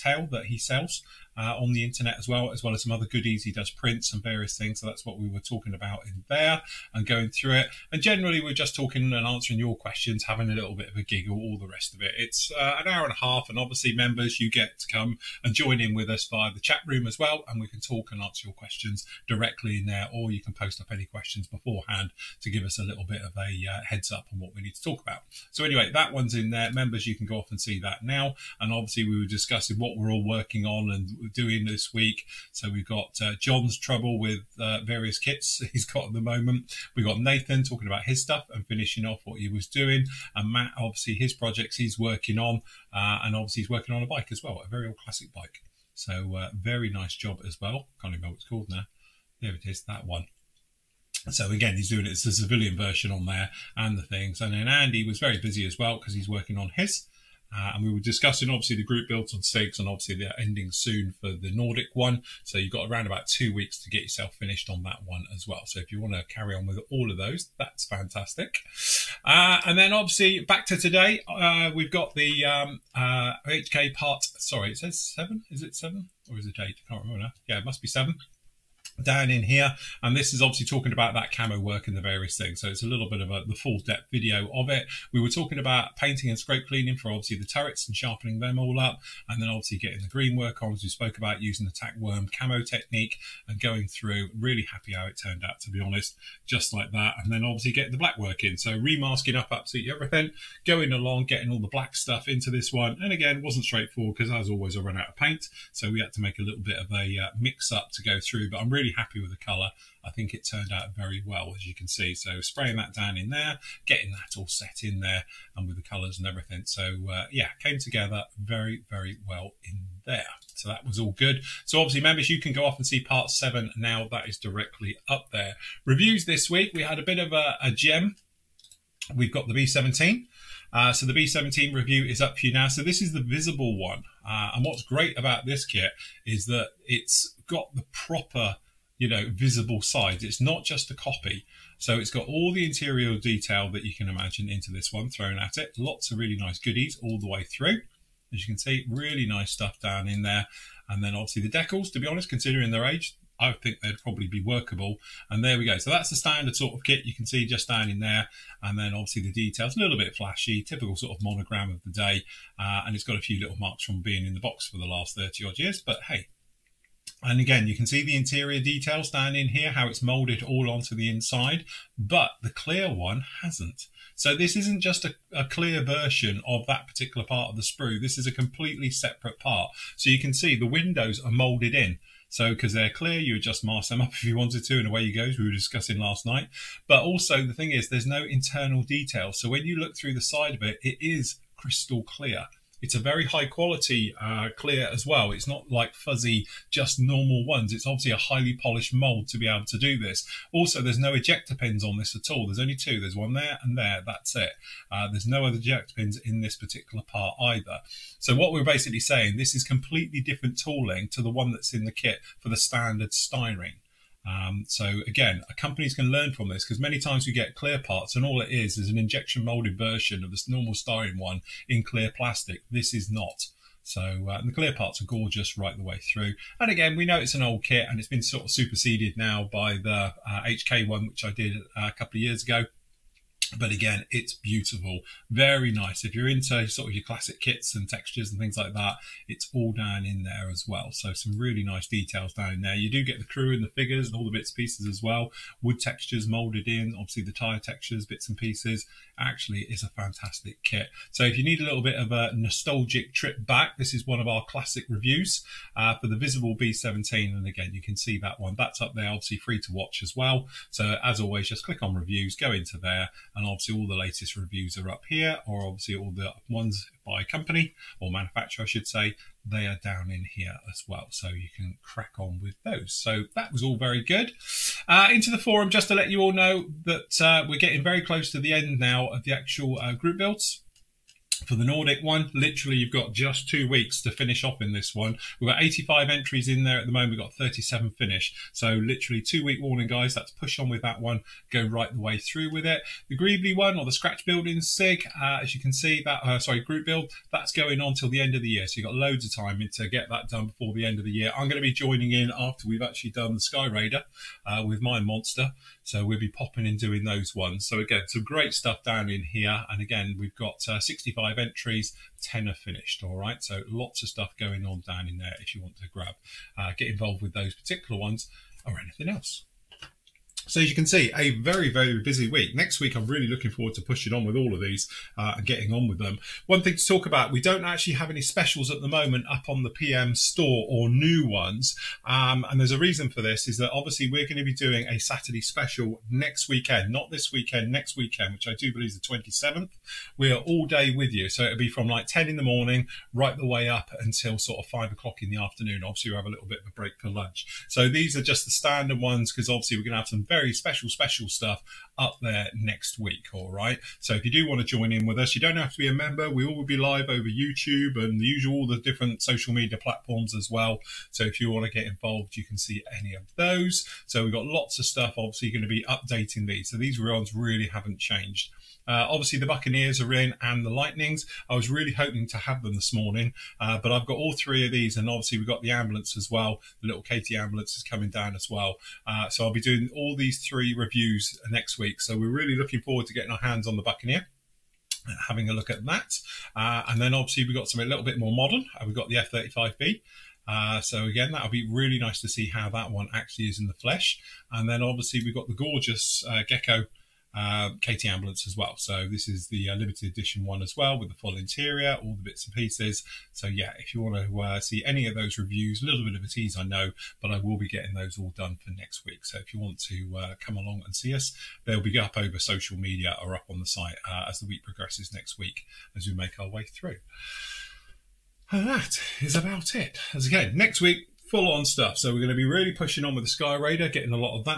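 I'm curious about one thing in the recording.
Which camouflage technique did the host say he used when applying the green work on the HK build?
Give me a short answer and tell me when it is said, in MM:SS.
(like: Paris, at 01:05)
tack worm camo technique, at 01:31.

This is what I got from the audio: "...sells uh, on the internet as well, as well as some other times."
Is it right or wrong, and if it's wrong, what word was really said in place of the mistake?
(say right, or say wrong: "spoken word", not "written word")
wrong: "goodies", not "times".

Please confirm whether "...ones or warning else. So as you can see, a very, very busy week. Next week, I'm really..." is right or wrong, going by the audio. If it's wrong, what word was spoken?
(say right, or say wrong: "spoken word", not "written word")
wrong: "anything", not "warning".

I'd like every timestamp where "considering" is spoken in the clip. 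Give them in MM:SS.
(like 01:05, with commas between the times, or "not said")
02:32.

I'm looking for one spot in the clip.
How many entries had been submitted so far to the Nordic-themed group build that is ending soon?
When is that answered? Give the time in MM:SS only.
04:45.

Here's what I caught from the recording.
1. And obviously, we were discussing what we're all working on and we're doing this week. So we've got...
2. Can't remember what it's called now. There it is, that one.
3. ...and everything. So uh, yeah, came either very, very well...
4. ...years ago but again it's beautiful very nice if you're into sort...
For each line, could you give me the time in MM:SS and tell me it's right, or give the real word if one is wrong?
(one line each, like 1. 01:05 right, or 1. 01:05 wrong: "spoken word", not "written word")
1. 00:28 right
2. 00:48 right
3. 01:56 wrong: "together", not "either"
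4. 03:52 right.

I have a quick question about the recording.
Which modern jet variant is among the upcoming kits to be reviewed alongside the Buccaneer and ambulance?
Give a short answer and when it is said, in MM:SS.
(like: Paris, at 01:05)
F-35B, at 06:29.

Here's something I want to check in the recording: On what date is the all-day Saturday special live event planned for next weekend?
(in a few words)
27th.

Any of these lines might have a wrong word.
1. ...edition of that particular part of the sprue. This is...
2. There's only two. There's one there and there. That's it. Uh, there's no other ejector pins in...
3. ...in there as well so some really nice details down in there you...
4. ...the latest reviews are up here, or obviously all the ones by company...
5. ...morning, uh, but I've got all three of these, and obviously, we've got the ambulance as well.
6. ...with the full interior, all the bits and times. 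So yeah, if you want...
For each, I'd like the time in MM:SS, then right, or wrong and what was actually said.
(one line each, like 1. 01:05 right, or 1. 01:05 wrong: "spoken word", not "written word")
1. 02:55 wrong: "version", not "edition"
2. 03:22 right
3. 04:00 right
4. 04:23 right
5. 06:12 right
6. 06:40 wrong: "pieces", not "times".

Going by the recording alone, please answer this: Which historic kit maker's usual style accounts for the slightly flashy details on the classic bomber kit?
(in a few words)
Monogram.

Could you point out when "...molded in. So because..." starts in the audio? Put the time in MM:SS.
03:01.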